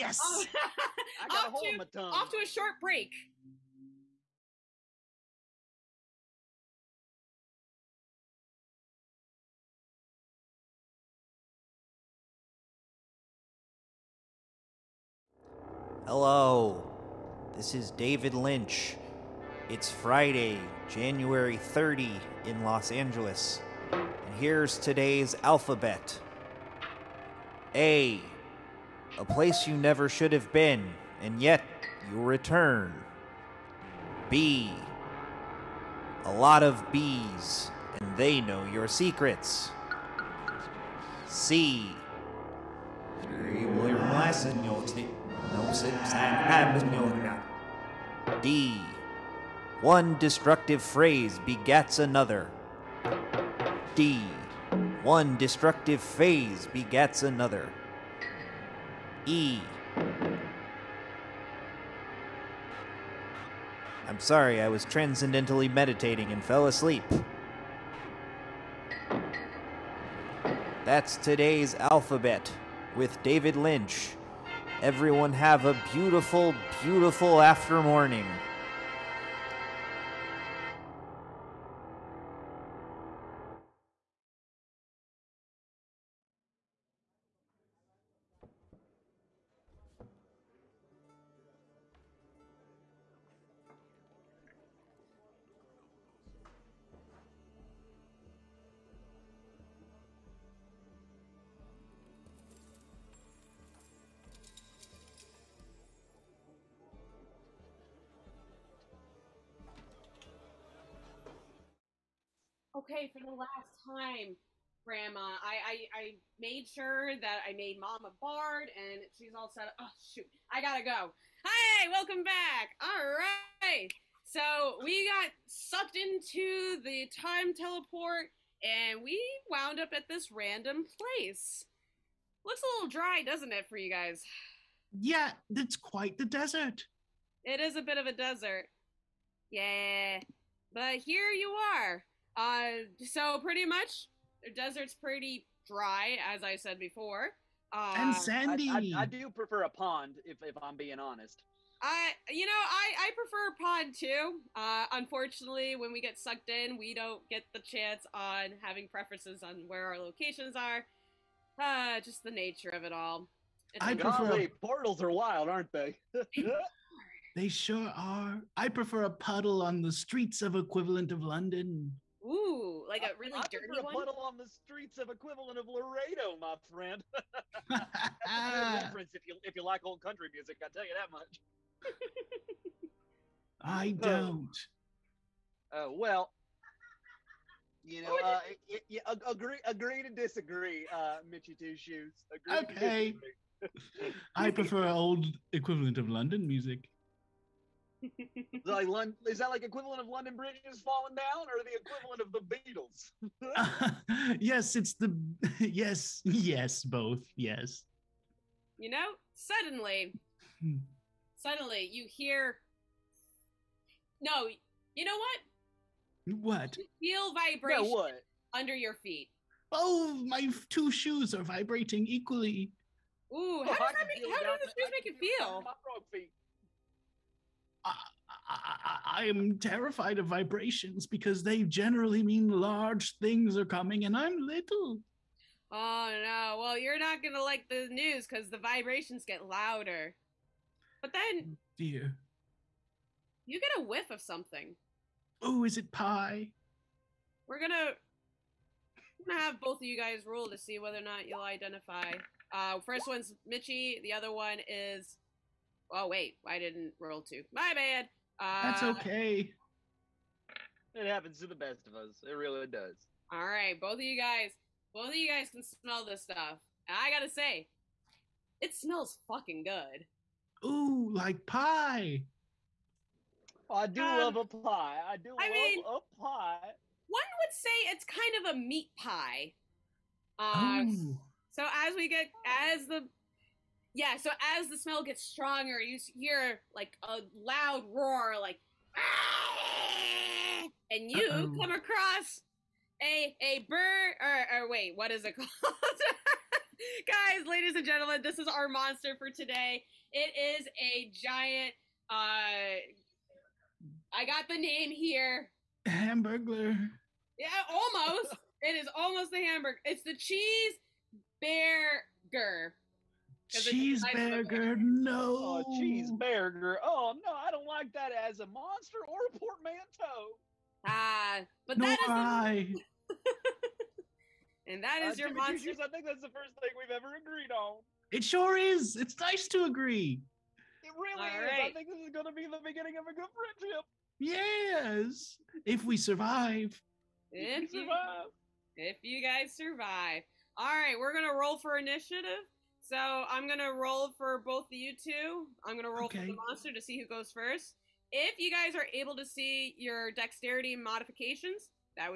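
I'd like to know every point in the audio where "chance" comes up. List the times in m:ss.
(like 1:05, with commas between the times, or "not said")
2:37.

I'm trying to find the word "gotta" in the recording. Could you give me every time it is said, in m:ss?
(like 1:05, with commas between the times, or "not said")
2:00, 4:27.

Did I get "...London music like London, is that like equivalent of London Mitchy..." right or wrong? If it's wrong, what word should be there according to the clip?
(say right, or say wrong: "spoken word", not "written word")
wrong: "Bridge", not "Mitchy".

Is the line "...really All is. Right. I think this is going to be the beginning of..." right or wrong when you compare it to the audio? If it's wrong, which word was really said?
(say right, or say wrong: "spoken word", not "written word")
right.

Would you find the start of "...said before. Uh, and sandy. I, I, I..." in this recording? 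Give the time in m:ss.
2:26.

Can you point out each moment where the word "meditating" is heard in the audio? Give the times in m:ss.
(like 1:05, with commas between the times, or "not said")
1:05.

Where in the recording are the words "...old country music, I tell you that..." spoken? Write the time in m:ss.
2:59.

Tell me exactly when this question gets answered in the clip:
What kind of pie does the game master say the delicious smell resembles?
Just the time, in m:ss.
4:38.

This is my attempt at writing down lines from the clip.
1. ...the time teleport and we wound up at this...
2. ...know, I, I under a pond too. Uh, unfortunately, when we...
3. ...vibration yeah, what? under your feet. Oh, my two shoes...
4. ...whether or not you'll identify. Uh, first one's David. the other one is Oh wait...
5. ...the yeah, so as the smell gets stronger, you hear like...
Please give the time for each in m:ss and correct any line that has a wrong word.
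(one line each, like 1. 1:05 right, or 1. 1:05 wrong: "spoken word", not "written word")
1. 2:06 right
2. 2:32 wrong: "prefer", not "under"
3. 3:37 right
4. 4:10 wrong: "Mitchy", not "David"
5. 4:42 right.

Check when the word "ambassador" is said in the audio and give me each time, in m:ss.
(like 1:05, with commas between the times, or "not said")
not said.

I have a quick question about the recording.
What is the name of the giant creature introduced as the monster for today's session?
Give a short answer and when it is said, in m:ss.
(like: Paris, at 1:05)
cheese bear, at 5:10.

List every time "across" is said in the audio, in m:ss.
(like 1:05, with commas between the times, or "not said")
4:51.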